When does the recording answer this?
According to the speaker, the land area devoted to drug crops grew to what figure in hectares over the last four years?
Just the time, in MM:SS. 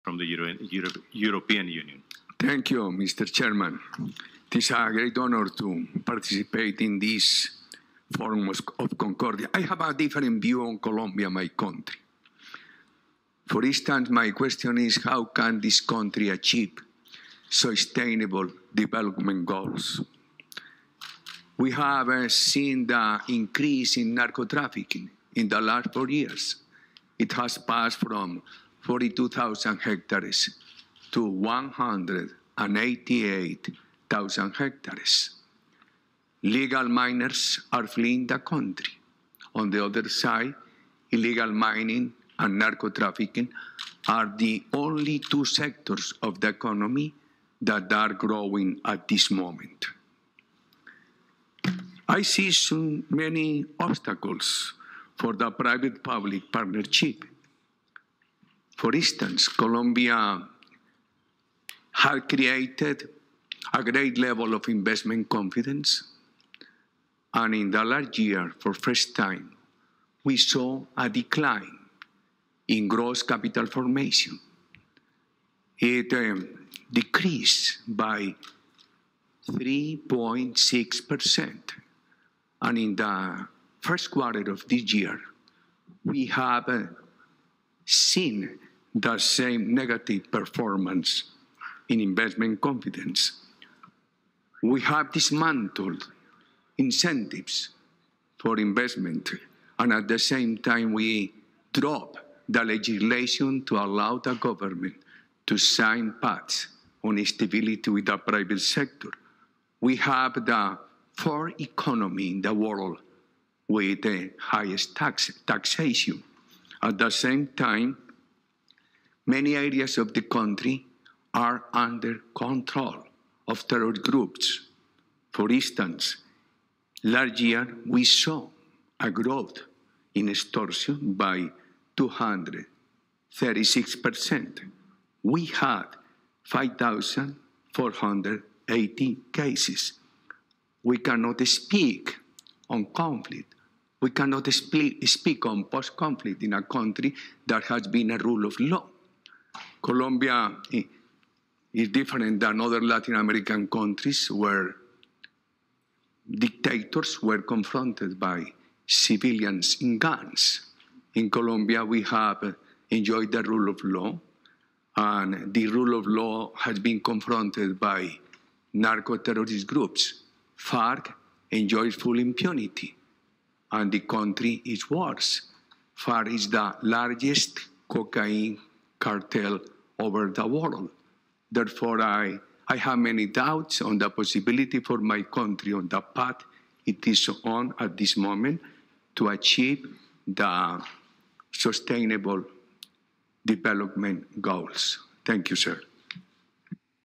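00:31.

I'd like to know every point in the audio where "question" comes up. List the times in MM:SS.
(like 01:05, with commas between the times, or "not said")
00:14.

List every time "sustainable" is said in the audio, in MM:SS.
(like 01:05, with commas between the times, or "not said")
00:17, 03:11.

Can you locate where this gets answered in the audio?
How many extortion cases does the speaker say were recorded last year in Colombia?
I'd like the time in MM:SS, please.
02:16.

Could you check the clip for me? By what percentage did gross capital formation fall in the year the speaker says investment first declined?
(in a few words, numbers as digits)
3.6%.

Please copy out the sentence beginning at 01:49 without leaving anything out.
We have the fourth economy in the world with the highest tax, taxation.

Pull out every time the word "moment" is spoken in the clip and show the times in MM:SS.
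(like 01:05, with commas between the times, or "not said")
00:49, 03:08.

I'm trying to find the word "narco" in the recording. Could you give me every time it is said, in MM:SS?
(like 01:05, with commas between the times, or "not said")
00:24, 00:42, 02:48.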